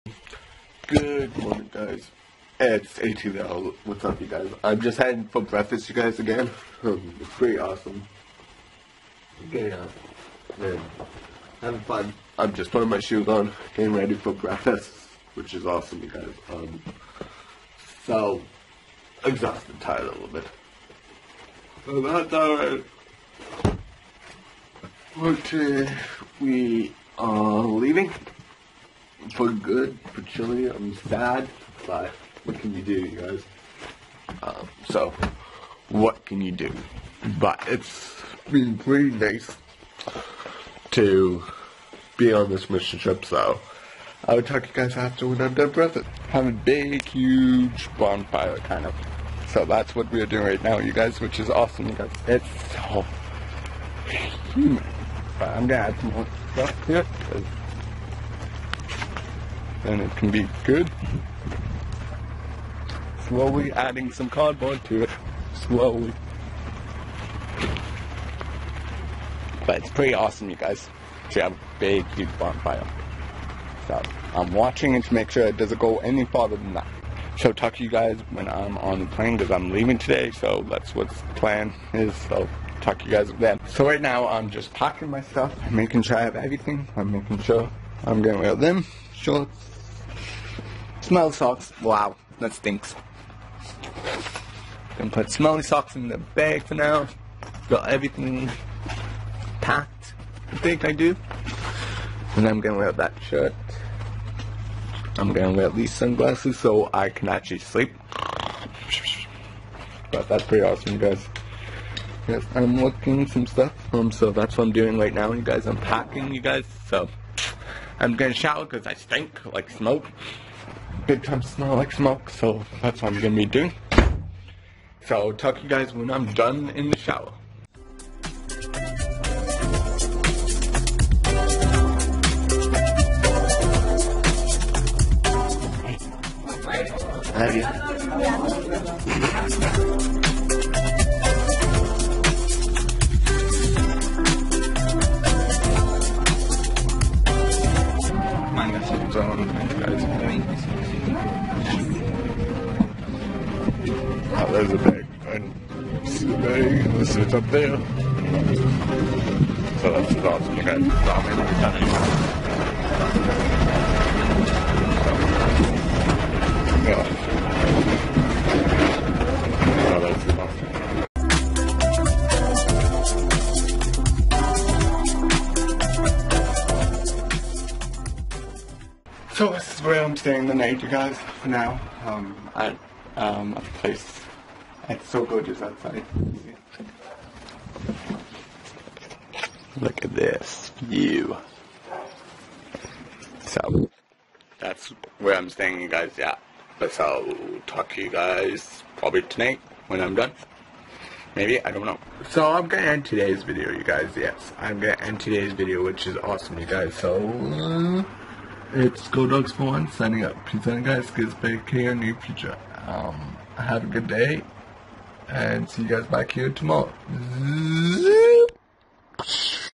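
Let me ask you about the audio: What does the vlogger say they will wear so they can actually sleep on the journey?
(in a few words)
Sunglasses.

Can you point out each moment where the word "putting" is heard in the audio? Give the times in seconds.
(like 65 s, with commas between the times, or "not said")
12 s.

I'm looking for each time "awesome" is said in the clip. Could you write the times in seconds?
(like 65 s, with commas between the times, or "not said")
7 s, 15 s, 51 s, 70 s, 110 s, 160 s, 206 s.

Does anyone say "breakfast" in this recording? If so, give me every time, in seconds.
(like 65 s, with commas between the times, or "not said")
5 s, 14 s.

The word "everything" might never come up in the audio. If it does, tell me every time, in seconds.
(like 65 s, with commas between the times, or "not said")
86 s, 97 s.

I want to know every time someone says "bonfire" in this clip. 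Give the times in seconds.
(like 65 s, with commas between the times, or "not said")
47 s, 72 s.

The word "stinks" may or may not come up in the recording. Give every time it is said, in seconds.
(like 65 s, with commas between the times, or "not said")
92 s, 118 s.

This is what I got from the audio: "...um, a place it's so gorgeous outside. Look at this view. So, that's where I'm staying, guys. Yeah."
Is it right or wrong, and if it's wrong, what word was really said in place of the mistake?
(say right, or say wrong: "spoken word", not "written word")
right.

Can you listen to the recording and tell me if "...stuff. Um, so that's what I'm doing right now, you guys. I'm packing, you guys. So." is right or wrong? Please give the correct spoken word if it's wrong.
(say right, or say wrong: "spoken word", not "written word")
right.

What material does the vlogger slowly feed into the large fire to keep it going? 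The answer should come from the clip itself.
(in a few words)
Cardboard.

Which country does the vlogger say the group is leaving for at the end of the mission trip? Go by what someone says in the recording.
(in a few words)
Chile.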